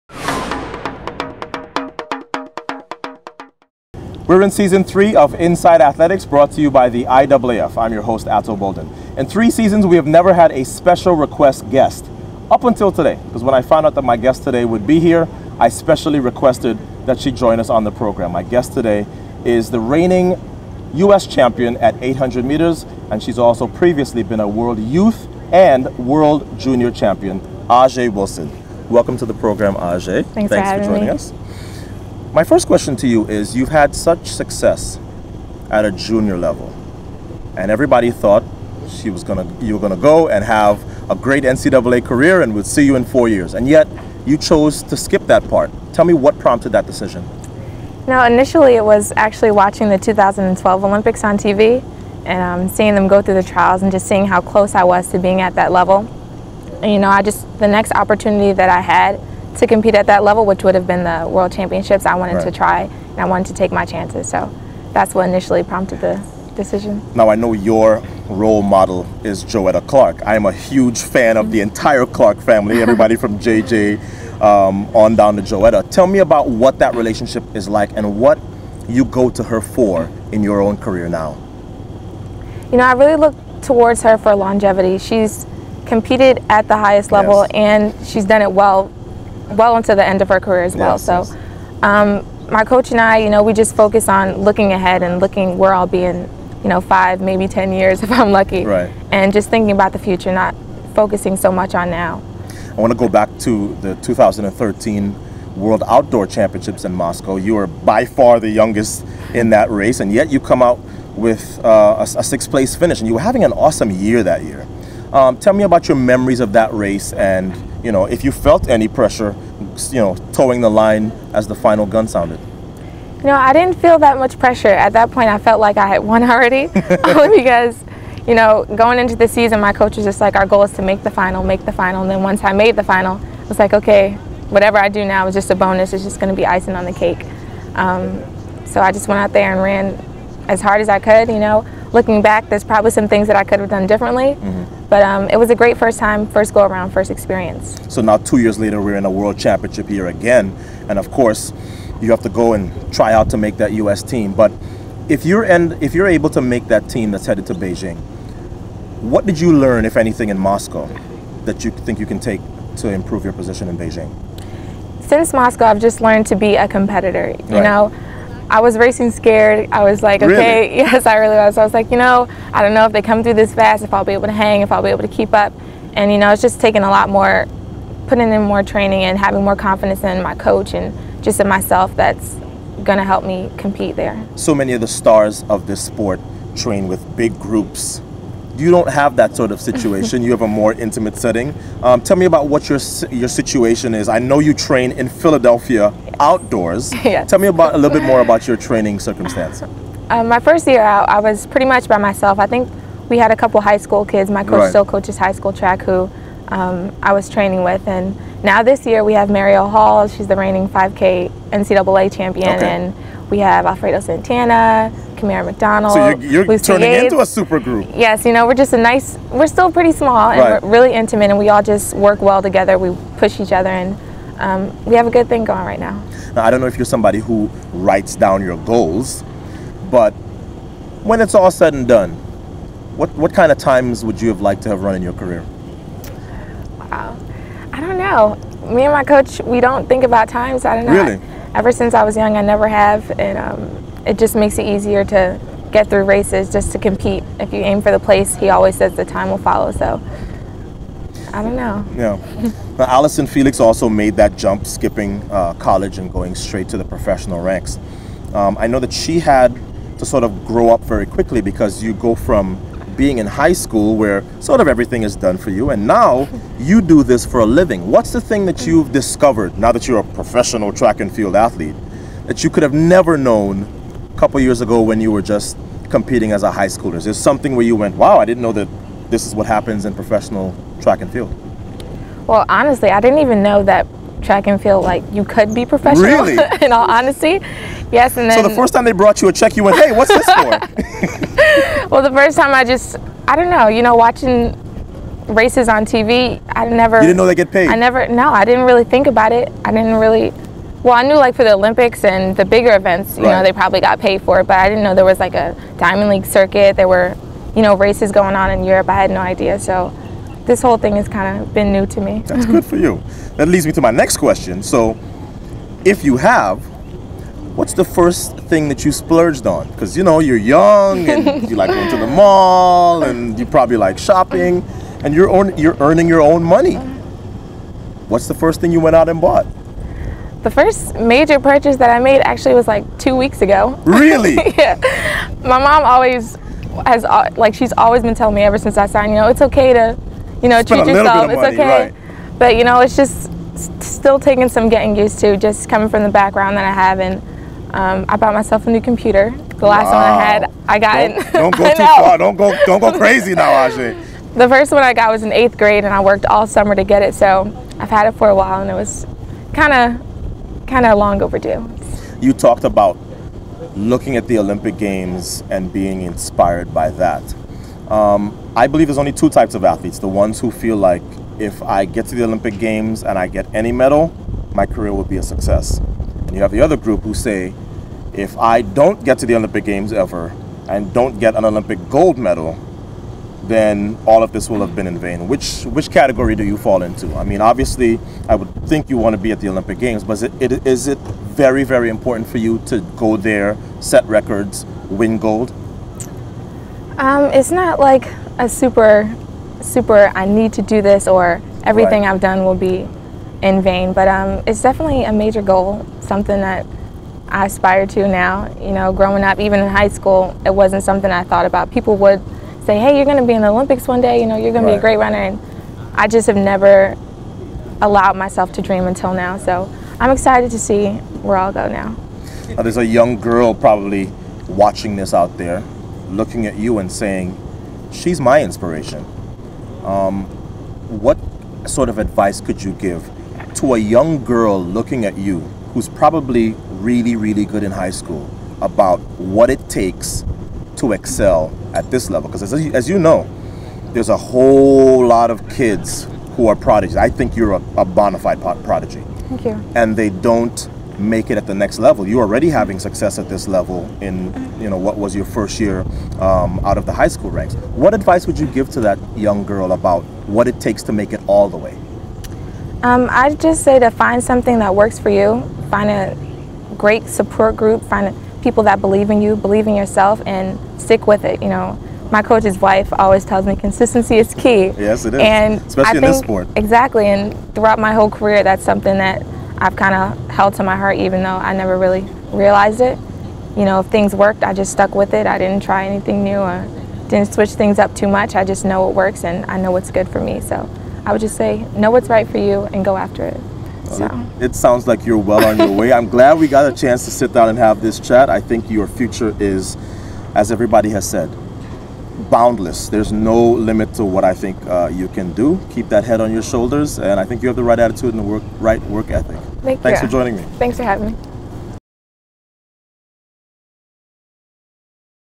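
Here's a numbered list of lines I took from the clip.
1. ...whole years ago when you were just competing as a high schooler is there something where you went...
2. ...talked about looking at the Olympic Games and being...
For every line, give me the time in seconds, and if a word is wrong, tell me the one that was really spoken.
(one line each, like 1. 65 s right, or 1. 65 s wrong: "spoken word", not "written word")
1. 274 s wrong: "couple", not "whole"
2. 362 s right.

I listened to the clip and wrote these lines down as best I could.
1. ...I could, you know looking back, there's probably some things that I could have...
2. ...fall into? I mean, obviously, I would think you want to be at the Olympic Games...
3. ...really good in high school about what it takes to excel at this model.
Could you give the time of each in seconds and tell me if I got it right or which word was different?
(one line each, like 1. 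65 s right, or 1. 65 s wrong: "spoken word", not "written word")
1. 140 s right
2. 386 s right
3. 437 s wrong: "level", not "model".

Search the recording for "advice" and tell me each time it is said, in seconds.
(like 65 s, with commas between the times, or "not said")
431 s, 457 s.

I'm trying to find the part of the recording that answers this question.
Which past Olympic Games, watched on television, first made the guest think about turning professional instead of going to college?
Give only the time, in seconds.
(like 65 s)
49 s.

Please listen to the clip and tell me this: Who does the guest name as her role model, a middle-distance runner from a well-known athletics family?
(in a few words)
Joetta Clark.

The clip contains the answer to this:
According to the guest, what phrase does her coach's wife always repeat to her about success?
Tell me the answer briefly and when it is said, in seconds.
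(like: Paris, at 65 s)
Consistency is key, at 473 s.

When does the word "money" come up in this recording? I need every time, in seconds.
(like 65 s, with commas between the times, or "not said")
326 s, 341 s.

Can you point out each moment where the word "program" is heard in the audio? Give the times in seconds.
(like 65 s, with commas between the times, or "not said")
17 s, 29 s.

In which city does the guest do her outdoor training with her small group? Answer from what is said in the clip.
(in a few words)
Philadelphia.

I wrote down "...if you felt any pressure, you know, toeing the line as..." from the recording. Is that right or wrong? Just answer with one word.
right.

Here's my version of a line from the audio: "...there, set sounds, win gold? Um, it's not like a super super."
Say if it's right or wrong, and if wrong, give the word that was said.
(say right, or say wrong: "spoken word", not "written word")
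wrong: "records", not "sounds".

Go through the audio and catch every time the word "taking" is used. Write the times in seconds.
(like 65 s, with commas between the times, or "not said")
176 s, 344 s.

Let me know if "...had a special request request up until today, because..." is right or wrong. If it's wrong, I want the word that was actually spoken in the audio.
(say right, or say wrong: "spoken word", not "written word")
wrong: "guest", not "request".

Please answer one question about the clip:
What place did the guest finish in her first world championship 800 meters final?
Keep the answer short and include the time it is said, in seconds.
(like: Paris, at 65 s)
6th, at 112 s.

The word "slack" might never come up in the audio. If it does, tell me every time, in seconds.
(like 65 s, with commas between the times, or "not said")
not said.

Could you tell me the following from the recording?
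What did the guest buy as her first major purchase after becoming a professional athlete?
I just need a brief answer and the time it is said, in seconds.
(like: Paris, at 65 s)
A new computer, at 348 s.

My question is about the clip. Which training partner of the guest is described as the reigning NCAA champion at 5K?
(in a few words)
Marielle Hall.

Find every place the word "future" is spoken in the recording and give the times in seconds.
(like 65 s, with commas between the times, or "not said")
99 s, 498 s.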